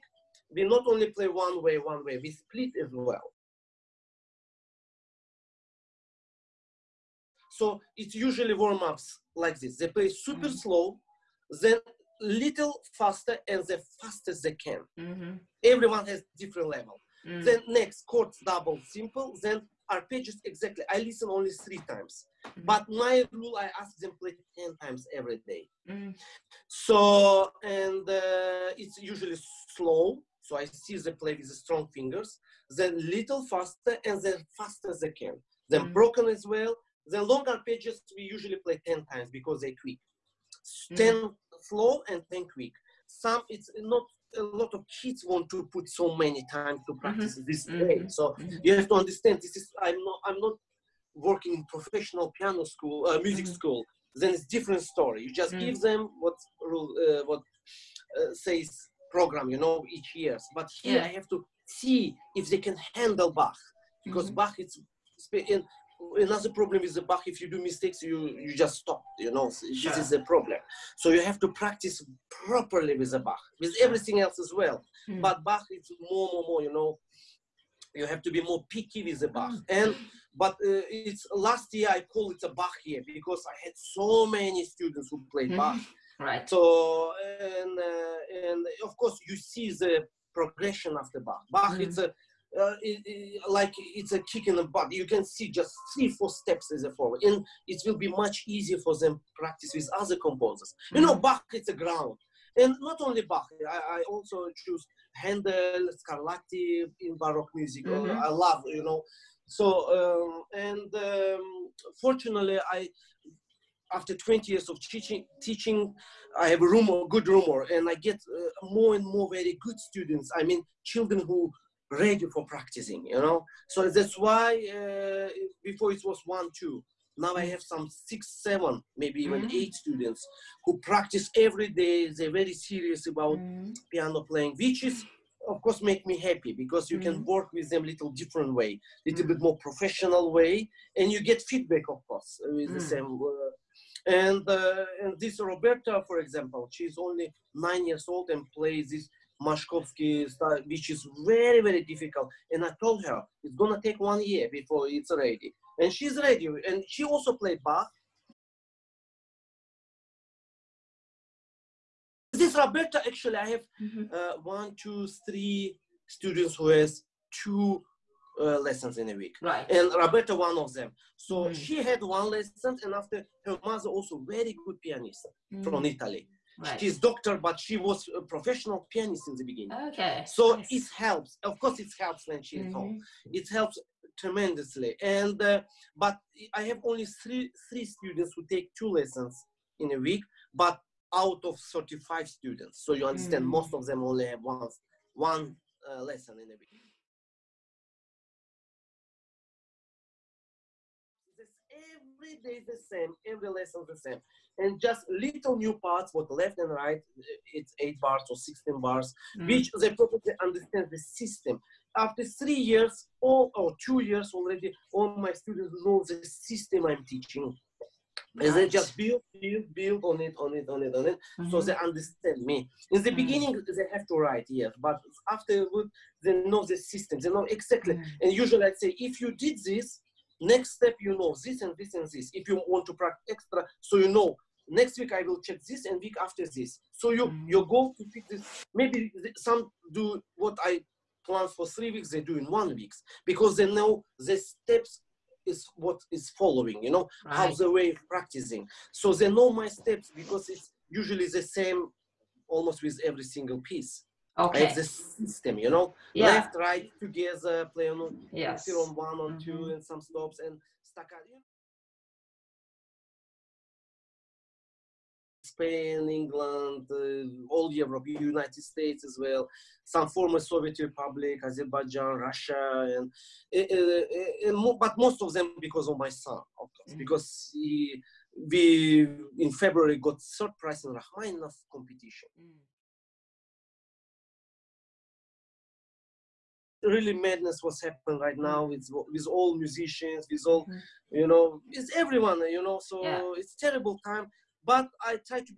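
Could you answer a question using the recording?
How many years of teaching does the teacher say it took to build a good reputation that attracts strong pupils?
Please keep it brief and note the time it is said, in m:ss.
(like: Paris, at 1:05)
20, at 1:54.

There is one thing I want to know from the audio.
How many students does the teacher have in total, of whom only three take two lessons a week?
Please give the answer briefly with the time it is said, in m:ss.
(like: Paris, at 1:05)
35, at 3:11.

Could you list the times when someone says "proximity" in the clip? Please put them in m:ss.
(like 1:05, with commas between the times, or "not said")
not said.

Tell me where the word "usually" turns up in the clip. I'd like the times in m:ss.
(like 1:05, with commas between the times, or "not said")
0:08, 0:29, 0:38, 3:48, 4:10.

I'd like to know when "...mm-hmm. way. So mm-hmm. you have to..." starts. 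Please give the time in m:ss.
0:47.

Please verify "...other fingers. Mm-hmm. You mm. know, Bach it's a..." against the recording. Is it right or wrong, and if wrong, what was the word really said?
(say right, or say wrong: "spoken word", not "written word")
wrong: "composers", not "fingers".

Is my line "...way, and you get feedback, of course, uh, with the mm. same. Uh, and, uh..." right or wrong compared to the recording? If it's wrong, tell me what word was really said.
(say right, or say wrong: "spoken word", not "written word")
right.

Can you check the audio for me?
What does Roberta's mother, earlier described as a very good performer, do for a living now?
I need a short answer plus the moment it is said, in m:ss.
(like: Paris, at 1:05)
Doctor, at 2:56.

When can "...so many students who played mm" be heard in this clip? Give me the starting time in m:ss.
1:23.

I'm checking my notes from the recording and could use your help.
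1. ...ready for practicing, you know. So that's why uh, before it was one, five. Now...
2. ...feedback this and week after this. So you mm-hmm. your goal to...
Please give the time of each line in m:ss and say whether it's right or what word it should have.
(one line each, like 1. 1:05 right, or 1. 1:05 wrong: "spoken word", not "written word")
1. 2:01 wrong: "two", not "five"
2. 3:55 wrong: "check", not "feedback".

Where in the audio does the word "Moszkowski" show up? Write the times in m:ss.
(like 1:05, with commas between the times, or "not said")
2:29.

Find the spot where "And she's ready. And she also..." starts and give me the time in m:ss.
2:35.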